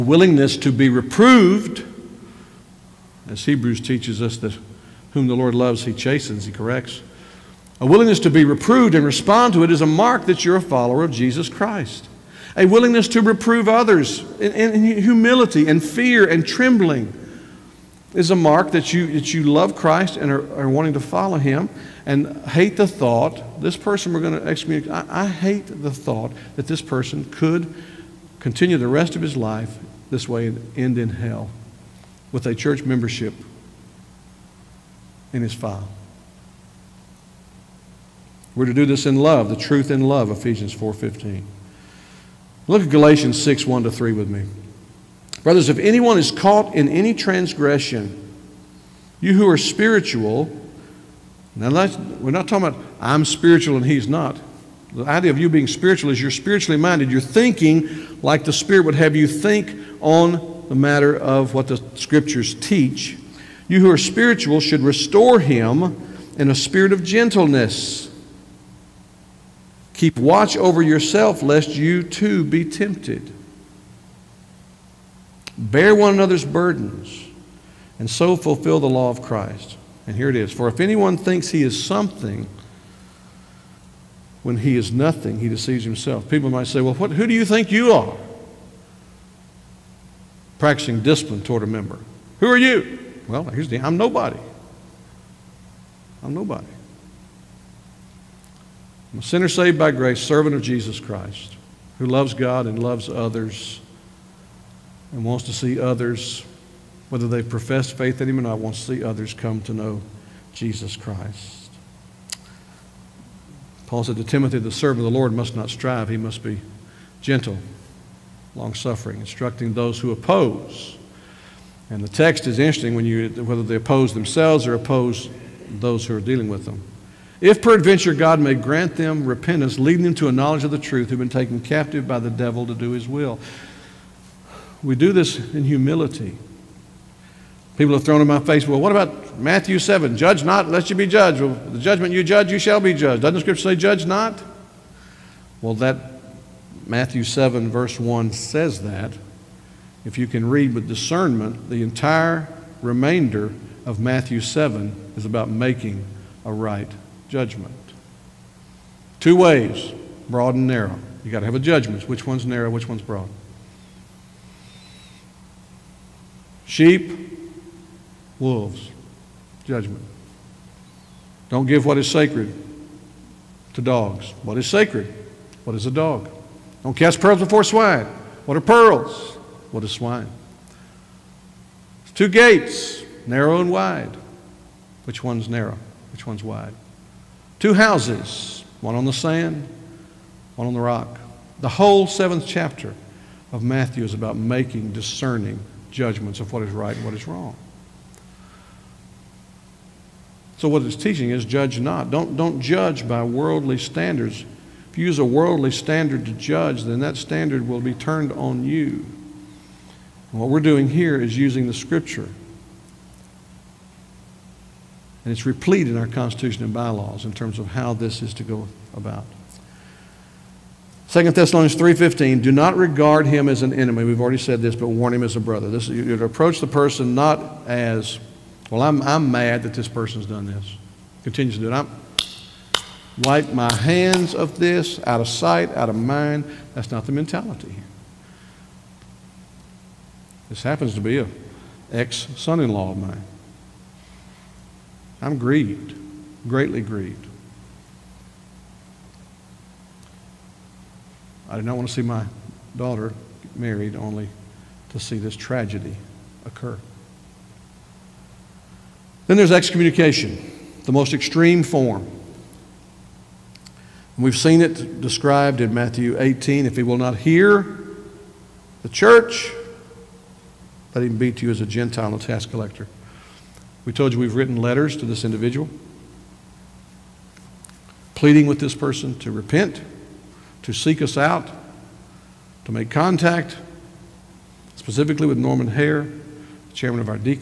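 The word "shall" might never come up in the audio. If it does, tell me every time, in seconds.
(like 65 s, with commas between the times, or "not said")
142 s.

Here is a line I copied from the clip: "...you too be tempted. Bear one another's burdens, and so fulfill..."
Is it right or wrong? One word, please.
right.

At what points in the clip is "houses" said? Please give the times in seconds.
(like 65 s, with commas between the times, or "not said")
187 s.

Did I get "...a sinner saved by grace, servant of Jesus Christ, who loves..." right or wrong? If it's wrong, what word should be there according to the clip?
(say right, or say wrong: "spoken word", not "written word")
right.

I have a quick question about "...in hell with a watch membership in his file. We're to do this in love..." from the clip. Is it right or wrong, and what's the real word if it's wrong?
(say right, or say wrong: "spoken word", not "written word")
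wrong: "church", not "watch".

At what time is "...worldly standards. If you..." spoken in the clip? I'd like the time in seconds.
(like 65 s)
203 s.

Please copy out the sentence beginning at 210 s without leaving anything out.
And what we're doing here is using the scripture.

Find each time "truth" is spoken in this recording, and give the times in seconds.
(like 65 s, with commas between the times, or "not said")
39 s, 130 s.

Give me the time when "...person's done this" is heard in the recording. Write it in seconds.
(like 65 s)
229 s.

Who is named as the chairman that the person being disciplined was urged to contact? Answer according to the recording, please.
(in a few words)
Norman Hare.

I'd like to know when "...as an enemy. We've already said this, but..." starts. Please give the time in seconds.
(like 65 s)
223 s.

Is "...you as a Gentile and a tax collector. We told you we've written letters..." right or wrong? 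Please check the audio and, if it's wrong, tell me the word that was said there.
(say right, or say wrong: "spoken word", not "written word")
right.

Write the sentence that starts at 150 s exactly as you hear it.
If you can read with discernment, the entire remainder of Matthew 7 is about making a right judgment.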